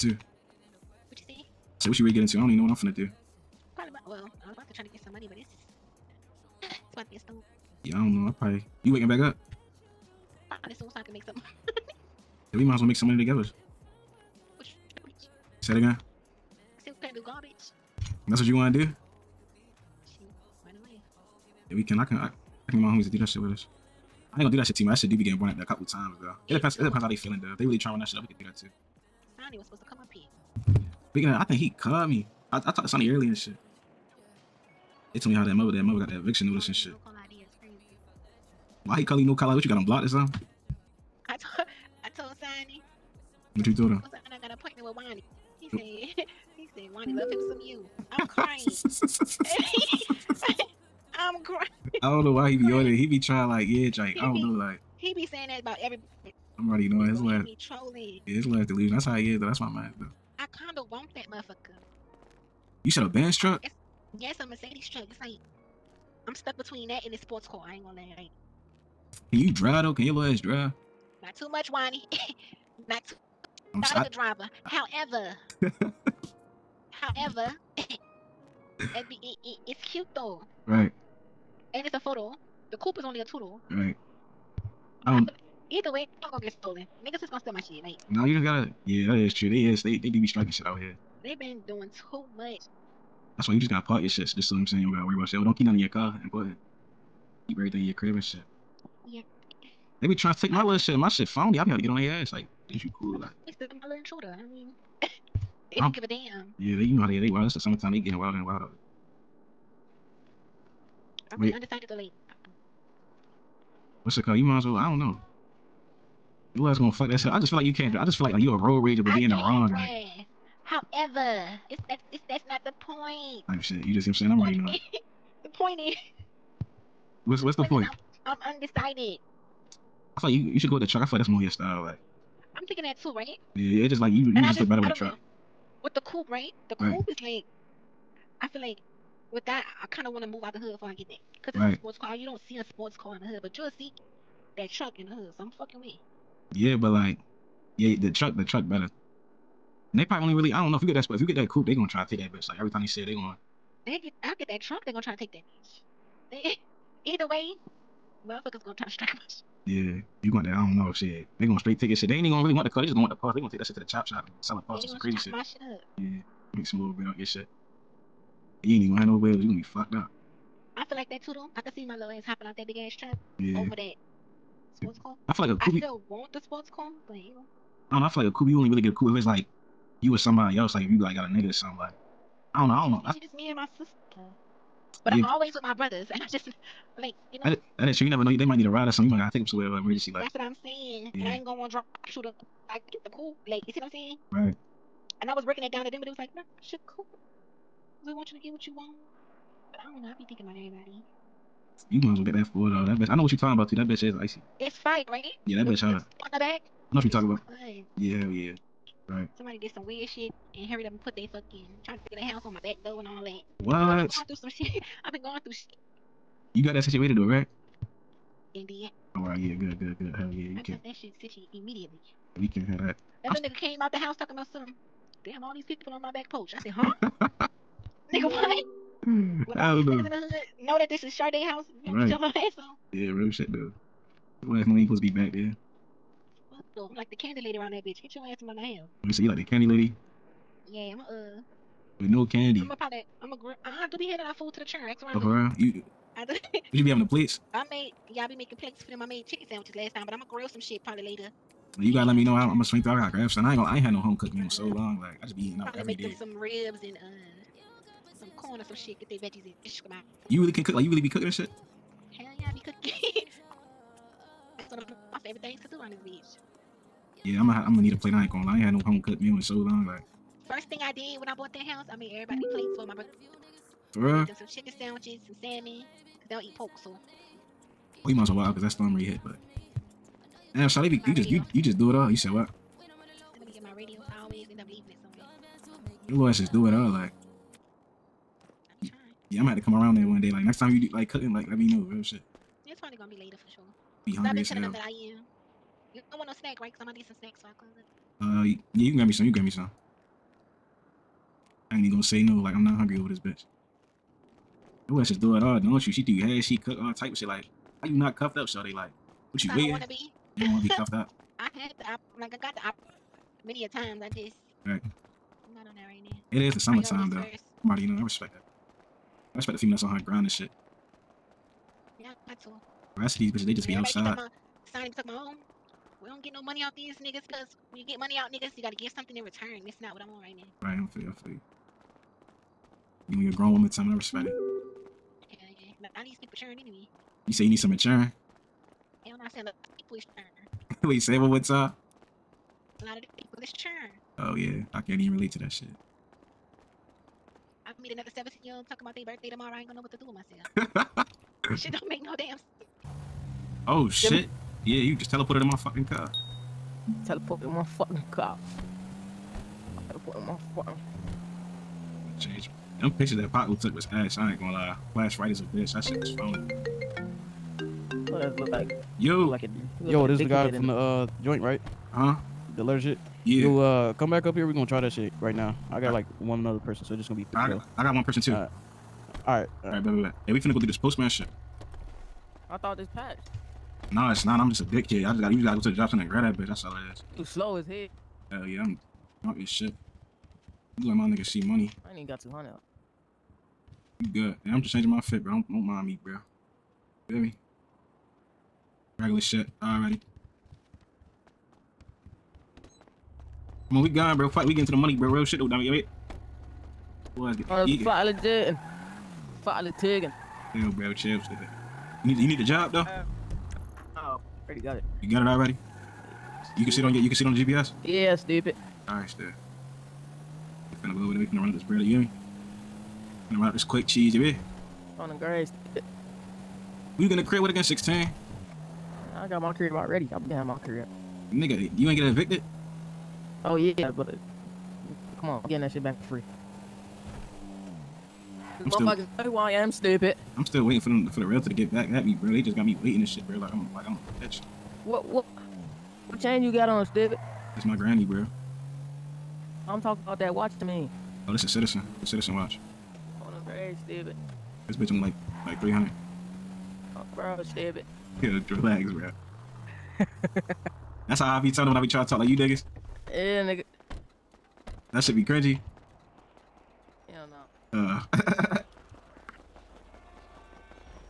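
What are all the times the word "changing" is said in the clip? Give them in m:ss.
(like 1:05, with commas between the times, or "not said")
6:34.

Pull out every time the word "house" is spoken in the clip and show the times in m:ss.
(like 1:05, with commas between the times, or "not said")
3:32, 3:43, 3:51, 4:31.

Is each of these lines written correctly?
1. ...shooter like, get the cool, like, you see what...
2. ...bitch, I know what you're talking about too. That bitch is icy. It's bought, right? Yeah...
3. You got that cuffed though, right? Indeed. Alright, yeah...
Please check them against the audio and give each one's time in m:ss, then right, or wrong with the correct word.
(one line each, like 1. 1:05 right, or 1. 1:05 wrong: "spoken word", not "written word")
1. 3:12 right
2. 3:22 wrong: "fight", not "bought"
3. 3:36 wrong: "situated", not "cuffed".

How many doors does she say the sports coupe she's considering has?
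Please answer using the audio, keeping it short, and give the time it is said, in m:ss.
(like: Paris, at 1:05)
2, at 1:23.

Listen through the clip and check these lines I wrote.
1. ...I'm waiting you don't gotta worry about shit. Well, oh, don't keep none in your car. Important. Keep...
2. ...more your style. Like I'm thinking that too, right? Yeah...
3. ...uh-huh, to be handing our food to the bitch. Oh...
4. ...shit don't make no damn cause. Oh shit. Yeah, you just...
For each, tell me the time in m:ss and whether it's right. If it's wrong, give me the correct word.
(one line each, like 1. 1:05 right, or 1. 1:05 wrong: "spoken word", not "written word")
1. 1:34 wrong: "saying", not "waiting"
2. 2:11 right
3. 4:03 wrong: "church", not "bitch"
4. 5:51 wrong: "sense", not "cause".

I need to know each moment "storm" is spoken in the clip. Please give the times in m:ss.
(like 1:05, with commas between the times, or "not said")
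0:07, 4:38.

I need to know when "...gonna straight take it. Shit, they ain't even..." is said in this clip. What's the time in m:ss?
2:41.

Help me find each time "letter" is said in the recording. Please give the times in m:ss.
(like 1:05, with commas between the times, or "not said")
6:12.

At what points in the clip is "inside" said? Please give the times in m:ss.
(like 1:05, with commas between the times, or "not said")
not said.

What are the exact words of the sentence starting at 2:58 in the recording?
You only really get a coupe if it's like you or somebody else.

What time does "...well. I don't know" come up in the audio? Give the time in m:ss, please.
1:54.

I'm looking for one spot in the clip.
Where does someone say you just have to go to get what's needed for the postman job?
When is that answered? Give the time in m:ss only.
6:25.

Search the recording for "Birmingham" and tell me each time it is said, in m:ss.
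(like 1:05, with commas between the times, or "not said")
not said.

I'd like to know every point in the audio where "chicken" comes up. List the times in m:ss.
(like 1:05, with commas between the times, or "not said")
4:09, 4:34.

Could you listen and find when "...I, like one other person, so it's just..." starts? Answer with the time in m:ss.
6:15.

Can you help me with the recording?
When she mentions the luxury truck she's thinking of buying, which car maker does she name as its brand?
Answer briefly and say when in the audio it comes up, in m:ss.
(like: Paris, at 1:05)
Mercedes, at 1:04.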